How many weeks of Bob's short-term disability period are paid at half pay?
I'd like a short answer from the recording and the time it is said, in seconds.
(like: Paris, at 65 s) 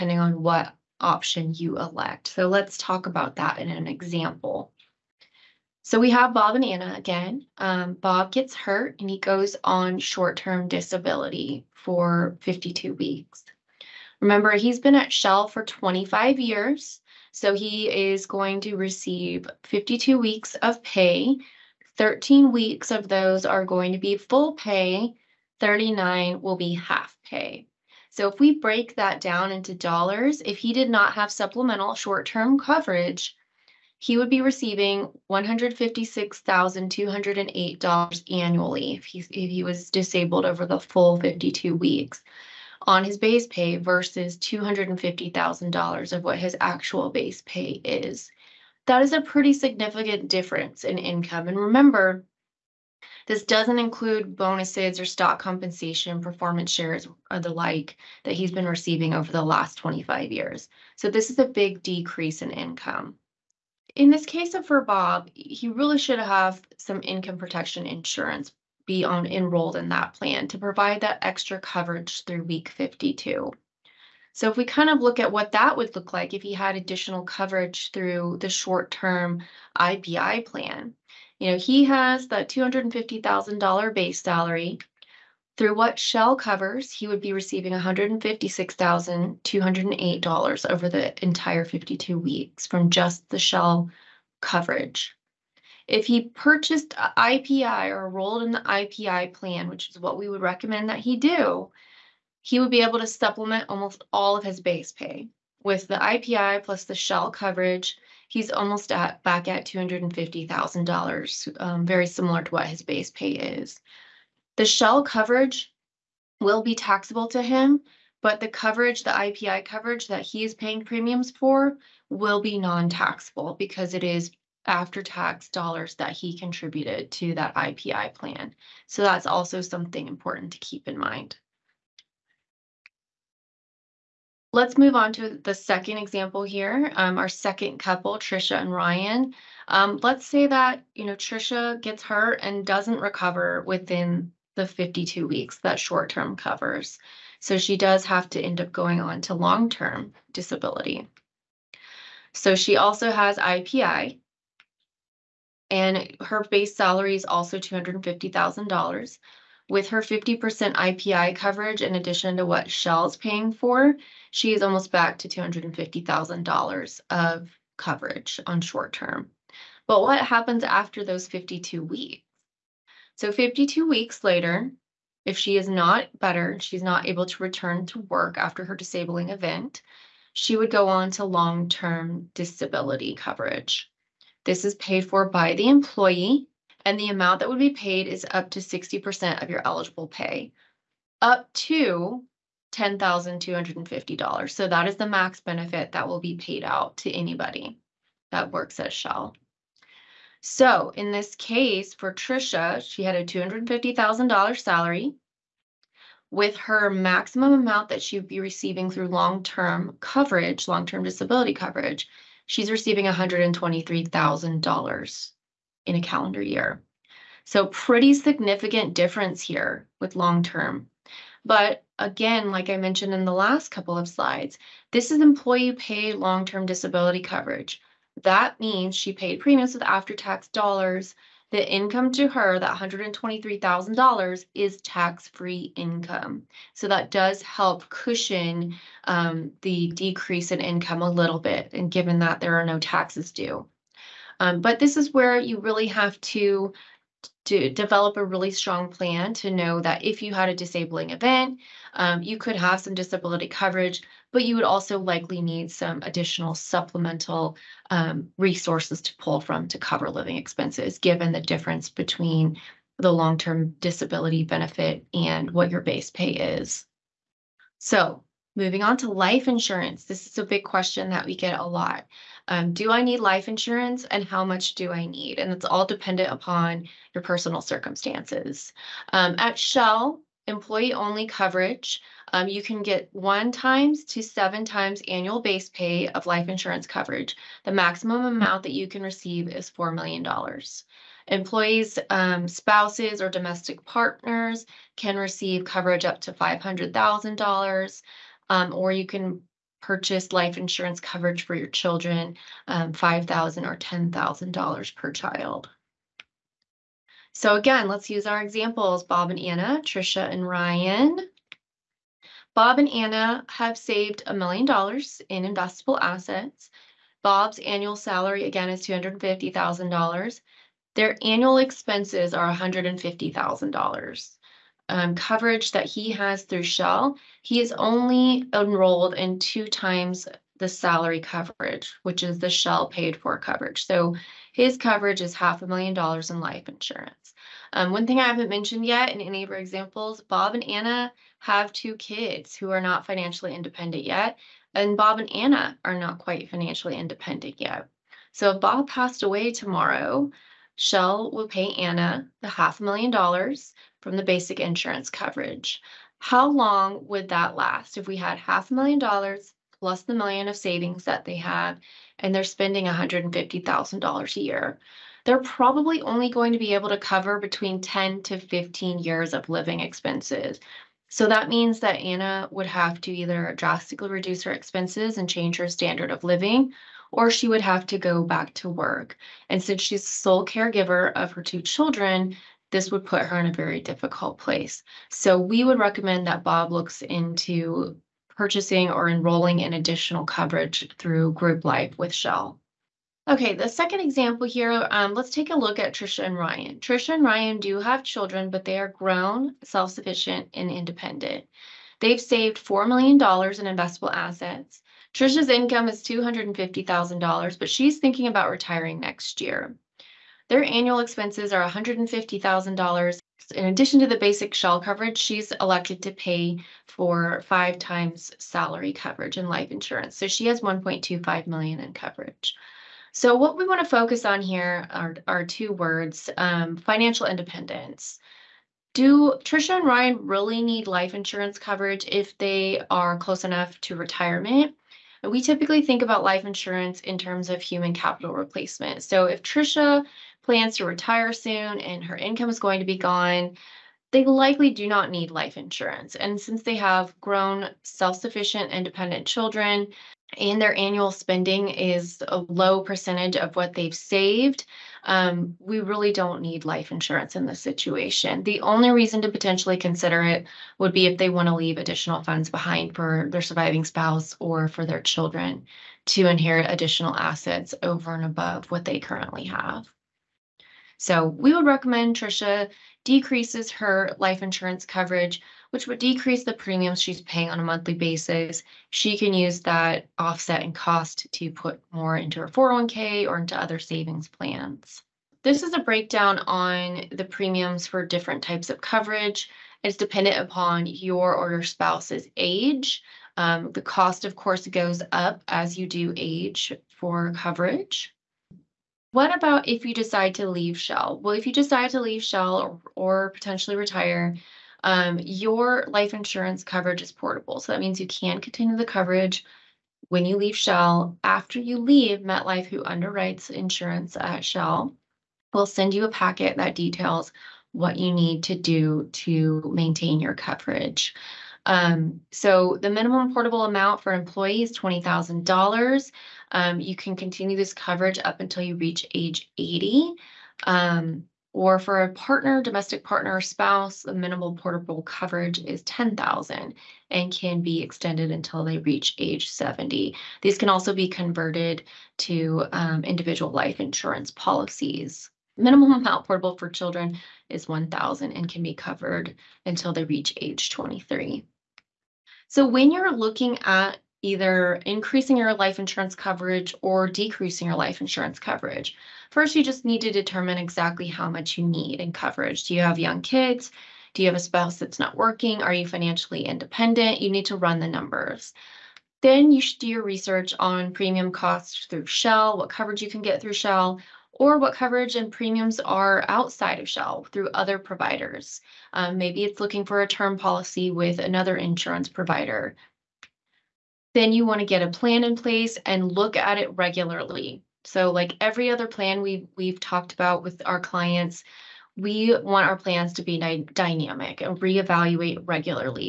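39, at 25 s.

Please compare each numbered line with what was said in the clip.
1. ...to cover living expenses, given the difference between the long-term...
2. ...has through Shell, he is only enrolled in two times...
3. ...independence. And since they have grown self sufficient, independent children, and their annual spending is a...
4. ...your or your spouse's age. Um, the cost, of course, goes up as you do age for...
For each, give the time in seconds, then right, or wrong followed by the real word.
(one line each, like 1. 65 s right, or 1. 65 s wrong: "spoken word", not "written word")
1. 259 s right
2. 326 s right
3. 445 s wrong: "insurance", not "independence"
4. 490 s right.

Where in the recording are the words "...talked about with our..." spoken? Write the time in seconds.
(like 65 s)
589 s.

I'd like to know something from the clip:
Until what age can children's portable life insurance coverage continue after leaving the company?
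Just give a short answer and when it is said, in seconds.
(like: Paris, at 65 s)
23, at 550 s.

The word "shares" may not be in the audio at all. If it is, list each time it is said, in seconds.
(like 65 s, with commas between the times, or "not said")
56 s.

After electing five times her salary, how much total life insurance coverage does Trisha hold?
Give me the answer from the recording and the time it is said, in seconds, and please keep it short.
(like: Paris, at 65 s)
1.25 million, at 420 s.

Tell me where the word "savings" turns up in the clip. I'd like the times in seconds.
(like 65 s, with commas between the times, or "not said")
360 s, 483 s.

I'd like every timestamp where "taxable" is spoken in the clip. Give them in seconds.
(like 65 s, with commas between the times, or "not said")
116 s, 122 s.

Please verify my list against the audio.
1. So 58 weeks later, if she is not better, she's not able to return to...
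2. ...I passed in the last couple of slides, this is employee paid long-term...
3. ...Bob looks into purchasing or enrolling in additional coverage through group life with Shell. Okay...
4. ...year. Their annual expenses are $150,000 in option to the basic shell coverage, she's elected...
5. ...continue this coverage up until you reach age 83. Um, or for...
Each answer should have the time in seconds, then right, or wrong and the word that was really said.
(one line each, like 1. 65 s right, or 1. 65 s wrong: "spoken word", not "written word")
1. 173 s wrong: "52", not "58"
2. 222 s wrong: "mentioned", not "passed"
3. 386 s right
4. 409 s wrong: "addition", not "option"
5. 527 s wrong: "80", not "83".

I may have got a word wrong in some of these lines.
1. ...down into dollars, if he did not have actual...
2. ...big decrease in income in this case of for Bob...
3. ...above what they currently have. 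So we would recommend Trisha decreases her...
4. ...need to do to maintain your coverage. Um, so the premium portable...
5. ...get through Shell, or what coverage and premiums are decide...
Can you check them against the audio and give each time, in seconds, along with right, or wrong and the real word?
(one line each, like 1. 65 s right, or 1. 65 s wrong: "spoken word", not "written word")
1. 29 s wrong: "supplemental", not "actual"
2. 61 s right
3. 468 s right
4. 518 s wrong: "minimum", not "premium"
5. 573 s wrong: "outside", not "decide".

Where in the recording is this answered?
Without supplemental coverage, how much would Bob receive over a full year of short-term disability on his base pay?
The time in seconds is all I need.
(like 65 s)
35 s.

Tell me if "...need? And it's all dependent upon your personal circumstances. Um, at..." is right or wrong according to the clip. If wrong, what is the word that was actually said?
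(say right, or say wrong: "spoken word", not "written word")
right.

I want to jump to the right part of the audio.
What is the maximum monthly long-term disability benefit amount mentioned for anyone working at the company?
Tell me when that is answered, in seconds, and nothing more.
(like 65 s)
192 s.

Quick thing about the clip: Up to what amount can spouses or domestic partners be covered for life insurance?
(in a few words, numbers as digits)
$500,000.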